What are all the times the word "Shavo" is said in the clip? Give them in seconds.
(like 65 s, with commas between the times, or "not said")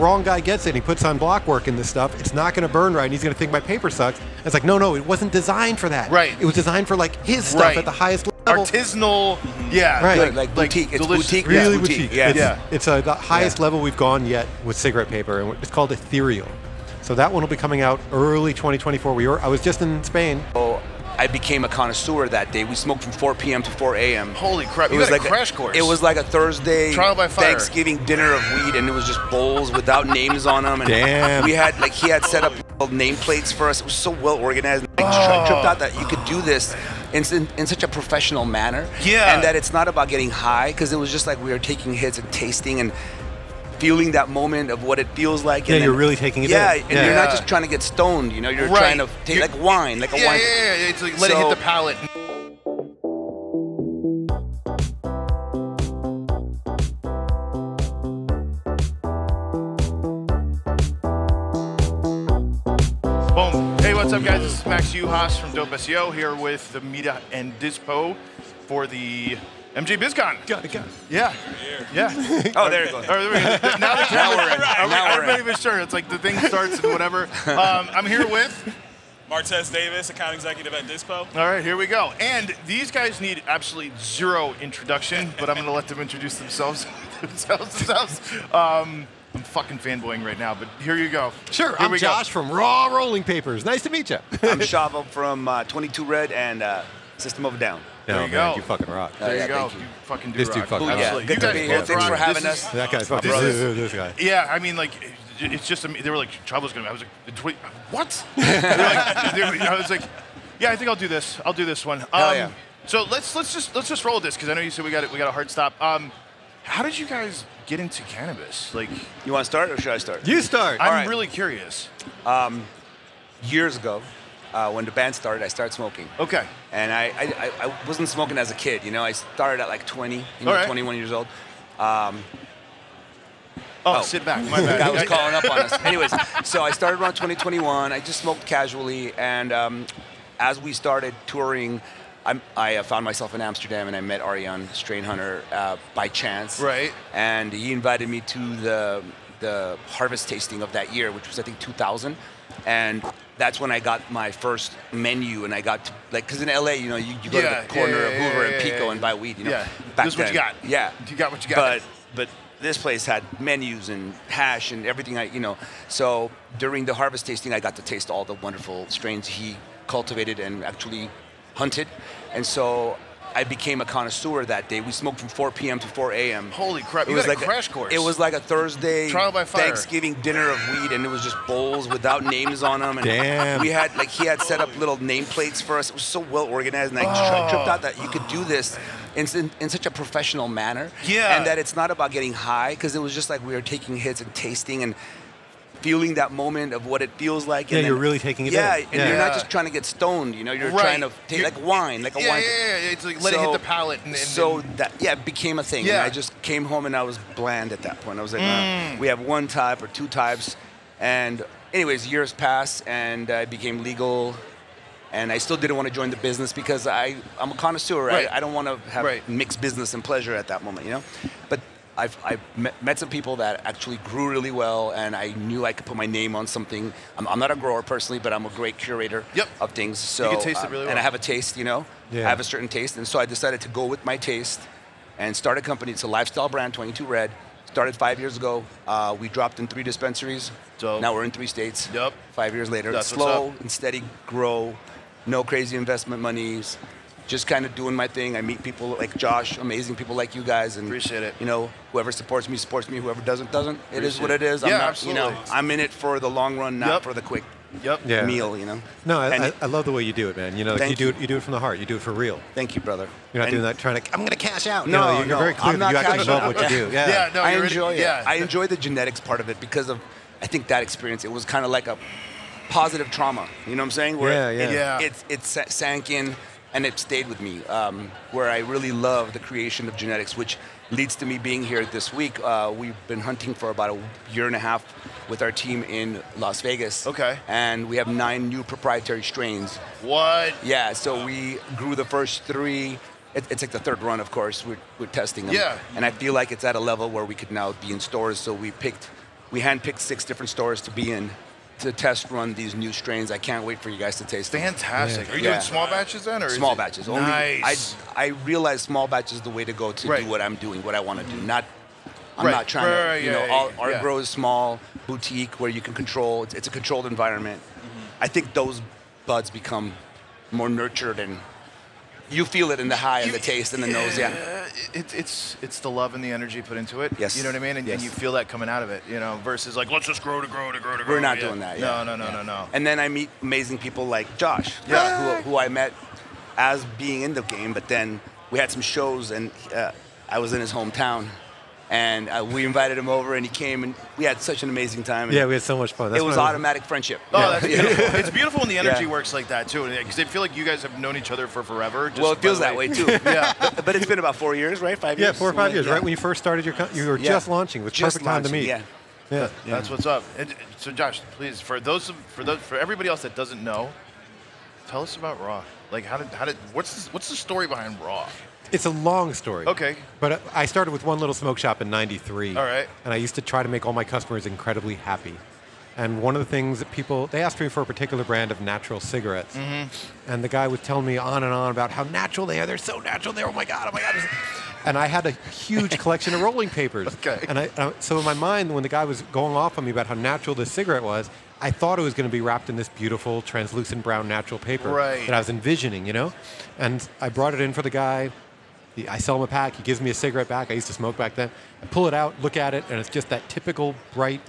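94 s.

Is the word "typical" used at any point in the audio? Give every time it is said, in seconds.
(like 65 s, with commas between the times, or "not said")
403 s.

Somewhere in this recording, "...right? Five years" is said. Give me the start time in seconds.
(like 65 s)
354 s.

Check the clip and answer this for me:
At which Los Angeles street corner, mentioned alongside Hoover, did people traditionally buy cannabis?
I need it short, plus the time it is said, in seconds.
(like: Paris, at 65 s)
Pico, at 158 s.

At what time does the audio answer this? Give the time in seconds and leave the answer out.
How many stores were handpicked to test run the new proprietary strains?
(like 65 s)
299 s.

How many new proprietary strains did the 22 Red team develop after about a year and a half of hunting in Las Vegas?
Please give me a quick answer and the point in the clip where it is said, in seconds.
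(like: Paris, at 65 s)
9, at 288 s.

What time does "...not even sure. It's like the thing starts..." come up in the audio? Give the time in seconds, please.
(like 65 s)
75 s.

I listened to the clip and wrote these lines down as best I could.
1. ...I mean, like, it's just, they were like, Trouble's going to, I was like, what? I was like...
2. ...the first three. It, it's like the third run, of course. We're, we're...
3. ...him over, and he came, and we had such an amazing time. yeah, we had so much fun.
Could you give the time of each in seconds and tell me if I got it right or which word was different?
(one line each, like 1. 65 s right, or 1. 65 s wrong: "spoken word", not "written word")
1. 104 s right
2. 291 s right
3. 342 s right.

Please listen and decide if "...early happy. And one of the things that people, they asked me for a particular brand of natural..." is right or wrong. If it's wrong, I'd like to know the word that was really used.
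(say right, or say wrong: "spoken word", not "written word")
wrong: "incredibly", not "early".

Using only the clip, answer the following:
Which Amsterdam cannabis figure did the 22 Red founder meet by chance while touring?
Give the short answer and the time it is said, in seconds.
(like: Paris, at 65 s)
Arjan Strainhunter, at 144 s.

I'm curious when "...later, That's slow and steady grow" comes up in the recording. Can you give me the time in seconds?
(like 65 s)
242 s.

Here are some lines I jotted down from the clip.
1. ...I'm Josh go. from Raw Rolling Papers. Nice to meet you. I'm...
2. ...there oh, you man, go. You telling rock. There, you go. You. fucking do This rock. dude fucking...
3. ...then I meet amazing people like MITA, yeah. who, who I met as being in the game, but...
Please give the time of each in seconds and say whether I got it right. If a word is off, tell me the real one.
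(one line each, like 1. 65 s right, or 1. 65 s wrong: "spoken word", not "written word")
1. 91 s right
2. 98 s wrong: "fucking", not "telling"
3. 332 s wrong: "Josh", not "MITA".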